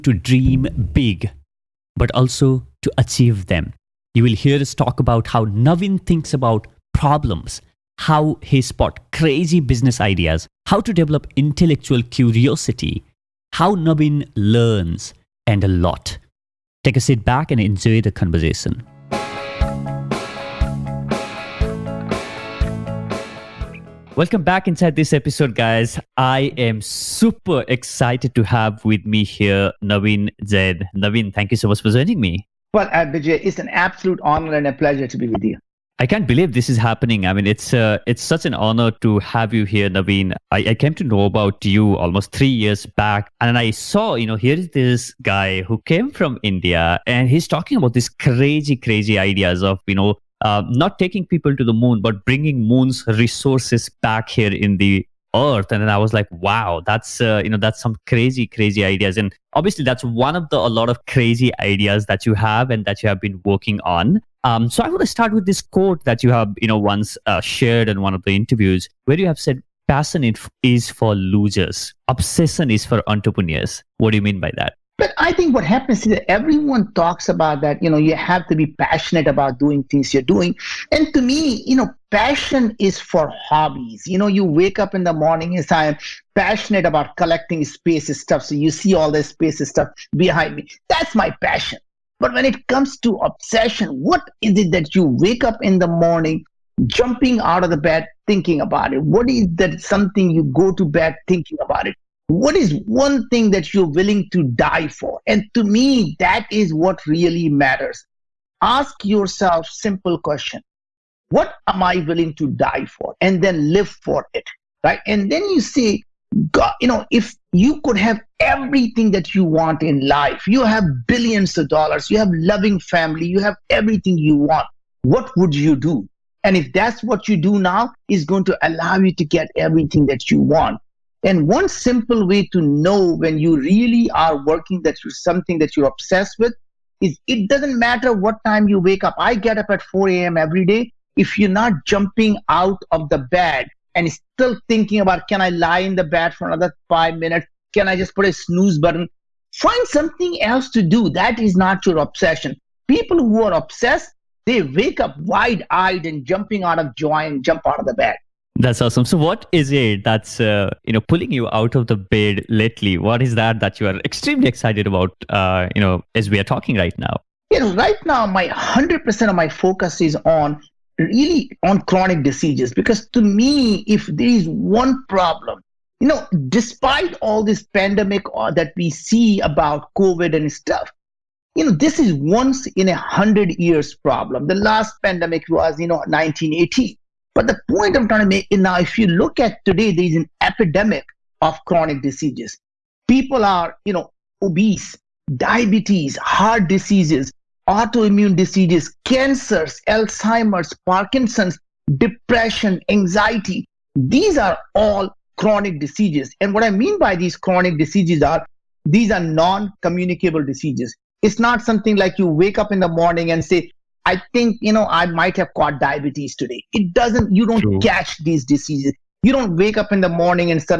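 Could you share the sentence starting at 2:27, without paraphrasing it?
Can I just put a snooze button?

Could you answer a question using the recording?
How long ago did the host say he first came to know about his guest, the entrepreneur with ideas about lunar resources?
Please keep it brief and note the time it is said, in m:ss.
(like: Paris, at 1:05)
3 years, at 0:42.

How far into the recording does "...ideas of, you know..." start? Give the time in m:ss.
0:49.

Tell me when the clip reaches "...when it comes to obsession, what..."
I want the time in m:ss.
1:32.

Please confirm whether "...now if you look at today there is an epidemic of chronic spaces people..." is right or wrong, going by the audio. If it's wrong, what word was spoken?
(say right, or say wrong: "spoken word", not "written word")
wrong: "diseases", not "spaces".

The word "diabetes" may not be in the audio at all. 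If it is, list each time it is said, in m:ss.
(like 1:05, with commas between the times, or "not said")
3:15, 3:35.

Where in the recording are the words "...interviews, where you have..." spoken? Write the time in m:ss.
1:08.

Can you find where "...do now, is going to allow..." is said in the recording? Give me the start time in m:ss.
2:07.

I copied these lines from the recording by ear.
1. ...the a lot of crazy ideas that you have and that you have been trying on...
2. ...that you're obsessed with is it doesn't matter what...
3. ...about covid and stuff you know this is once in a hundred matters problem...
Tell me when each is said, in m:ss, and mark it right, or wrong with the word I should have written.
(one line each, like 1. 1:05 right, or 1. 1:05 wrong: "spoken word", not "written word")
1. 1:00 wrong: "working", not "trying"
2. 2:15 right
3. 2:59 wrong: "years", not "matters".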